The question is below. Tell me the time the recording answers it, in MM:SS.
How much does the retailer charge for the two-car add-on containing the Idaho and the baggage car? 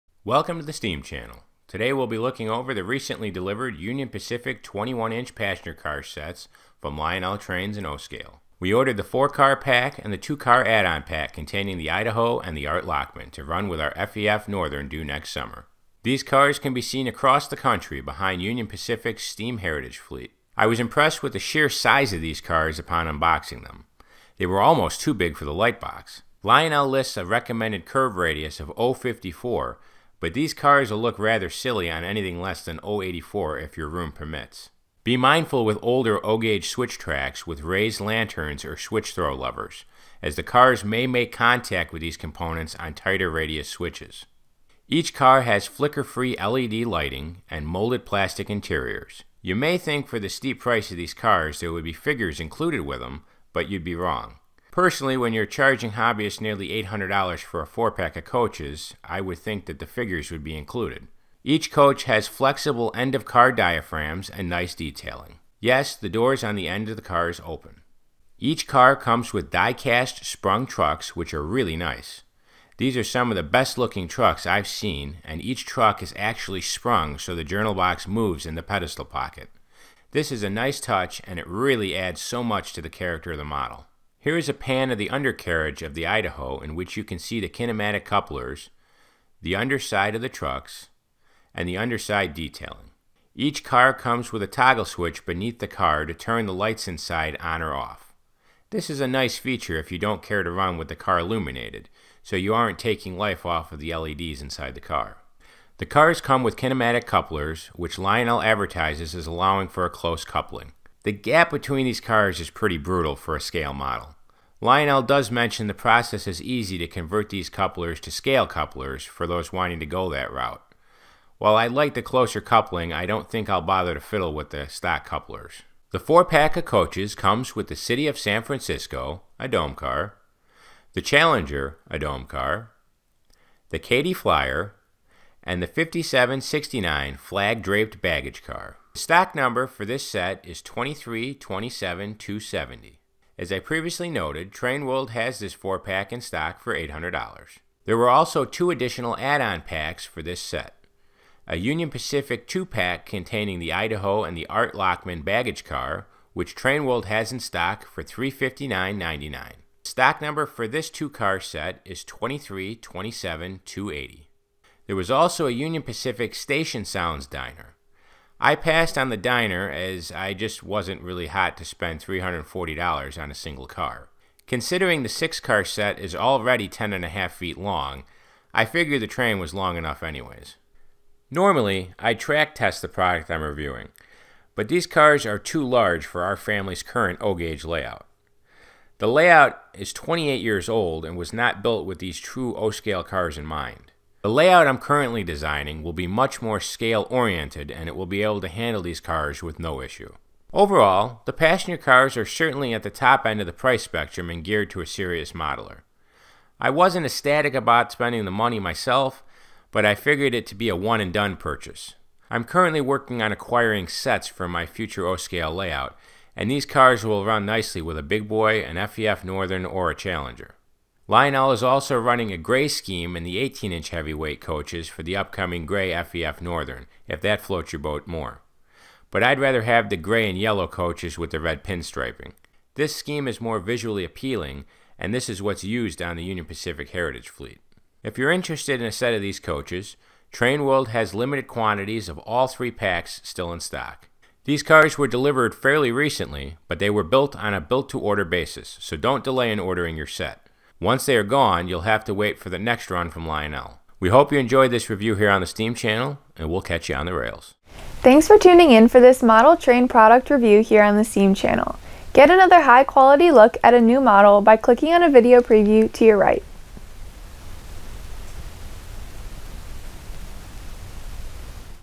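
02:38.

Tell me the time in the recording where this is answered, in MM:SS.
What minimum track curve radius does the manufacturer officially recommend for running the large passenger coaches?
00:28.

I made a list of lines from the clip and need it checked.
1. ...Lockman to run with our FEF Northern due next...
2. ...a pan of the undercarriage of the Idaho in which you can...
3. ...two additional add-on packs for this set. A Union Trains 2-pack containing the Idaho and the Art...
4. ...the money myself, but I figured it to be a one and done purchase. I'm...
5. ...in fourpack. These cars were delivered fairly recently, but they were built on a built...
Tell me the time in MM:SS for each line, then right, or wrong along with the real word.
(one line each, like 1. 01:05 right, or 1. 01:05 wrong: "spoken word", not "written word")
1. 00:12 right
2. 01:24 right
3. 02:28 wrong: "Pacific", not "Trains"
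4. 03:28 right
5. 04:03 wrong: "stock", not "fourpack".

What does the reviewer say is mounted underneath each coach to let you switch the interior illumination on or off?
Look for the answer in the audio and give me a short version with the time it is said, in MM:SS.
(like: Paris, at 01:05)
toggle switch, at 01:34.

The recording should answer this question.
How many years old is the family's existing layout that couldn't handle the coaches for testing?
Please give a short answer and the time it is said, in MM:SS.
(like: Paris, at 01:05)
28, at 03:09.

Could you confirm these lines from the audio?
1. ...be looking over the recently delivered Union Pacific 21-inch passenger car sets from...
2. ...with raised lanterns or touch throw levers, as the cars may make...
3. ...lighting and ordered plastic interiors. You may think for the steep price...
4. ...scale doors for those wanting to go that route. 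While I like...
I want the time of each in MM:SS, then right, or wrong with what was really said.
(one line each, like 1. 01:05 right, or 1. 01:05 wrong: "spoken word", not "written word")
1. 00:02 right
2. 00:37 wrong: "switch", not "touch"
3. 00:46 wrong: "molded", not "ordered"
4. 01:58 wrong: "couplers", not "doors".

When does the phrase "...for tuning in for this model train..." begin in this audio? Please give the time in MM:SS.
04:18.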